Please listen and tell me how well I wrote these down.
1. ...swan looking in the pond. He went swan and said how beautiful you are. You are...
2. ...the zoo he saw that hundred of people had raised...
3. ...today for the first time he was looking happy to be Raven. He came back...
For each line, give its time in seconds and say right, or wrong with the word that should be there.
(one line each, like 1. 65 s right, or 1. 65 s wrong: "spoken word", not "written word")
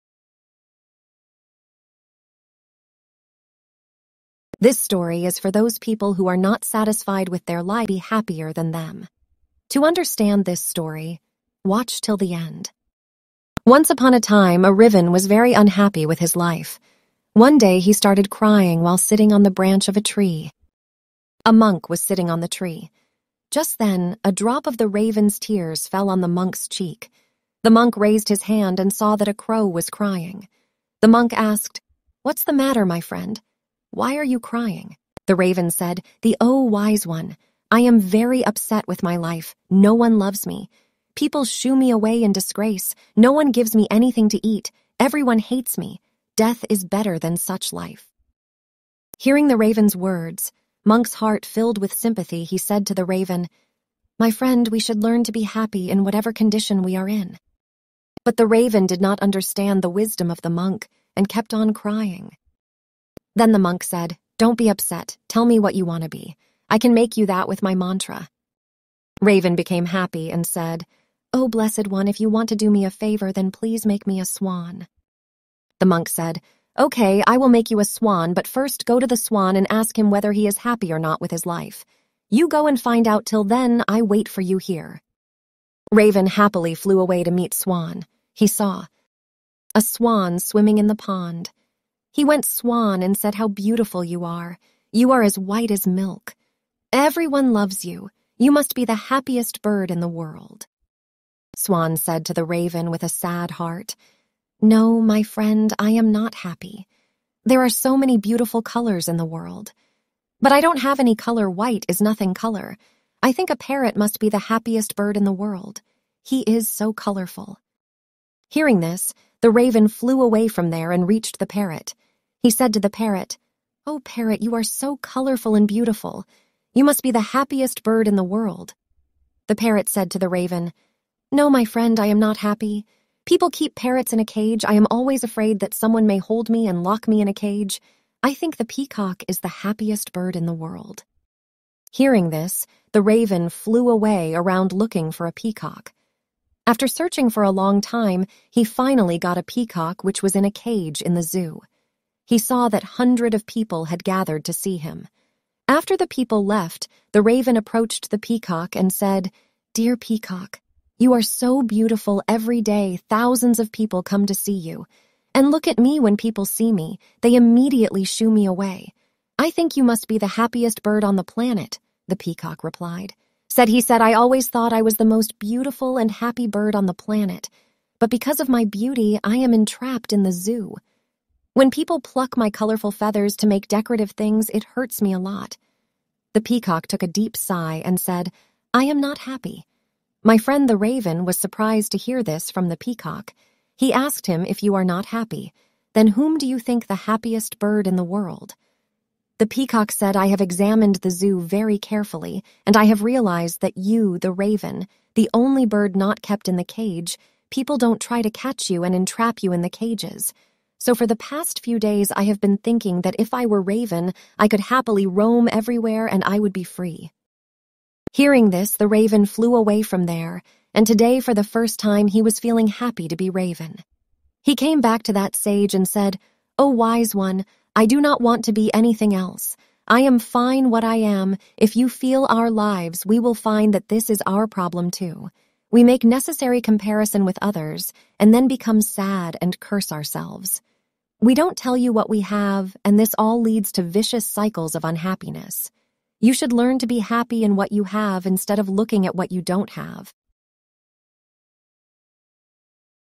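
1. 89 s wrong: "swimming", not "looking"
2. 151 s wrong: "gathered", not "raised"
3. 220 s wrong: "feeling", not "looking".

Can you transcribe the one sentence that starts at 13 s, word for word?
Once upon a time, a Riven was very unhappy with his life.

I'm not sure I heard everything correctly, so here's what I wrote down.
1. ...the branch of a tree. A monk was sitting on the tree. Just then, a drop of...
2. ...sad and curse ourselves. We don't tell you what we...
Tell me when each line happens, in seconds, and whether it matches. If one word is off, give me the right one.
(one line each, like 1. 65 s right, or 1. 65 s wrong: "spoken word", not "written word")
1. 19 s right
2. 238 s right.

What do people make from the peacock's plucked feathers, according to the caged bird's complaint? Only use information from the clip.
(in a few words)
decorative things.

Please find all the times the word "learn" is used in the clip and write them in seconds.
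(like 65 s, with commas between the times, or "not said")
55 s, 246 s.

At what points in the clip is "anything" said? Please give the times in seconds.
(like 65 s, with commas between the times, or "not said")
43 s, 228 s.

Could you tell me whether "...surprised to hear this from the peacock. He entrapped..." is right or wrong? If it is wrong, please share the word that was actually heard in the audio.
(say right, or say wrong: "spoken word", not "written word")
wrong: "asked", not "entrapped".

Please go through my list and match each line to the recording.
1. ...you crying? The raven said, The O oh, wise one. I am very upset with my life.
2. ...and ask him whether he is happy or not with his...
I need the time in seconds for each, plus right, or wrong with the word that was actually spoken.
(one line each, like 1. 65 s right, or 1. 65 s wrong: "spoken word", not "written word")
1. 34 s right
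2. 79 s right.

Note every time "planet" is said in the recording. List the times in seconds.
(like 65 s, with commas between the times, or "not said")
171 s, 176 s.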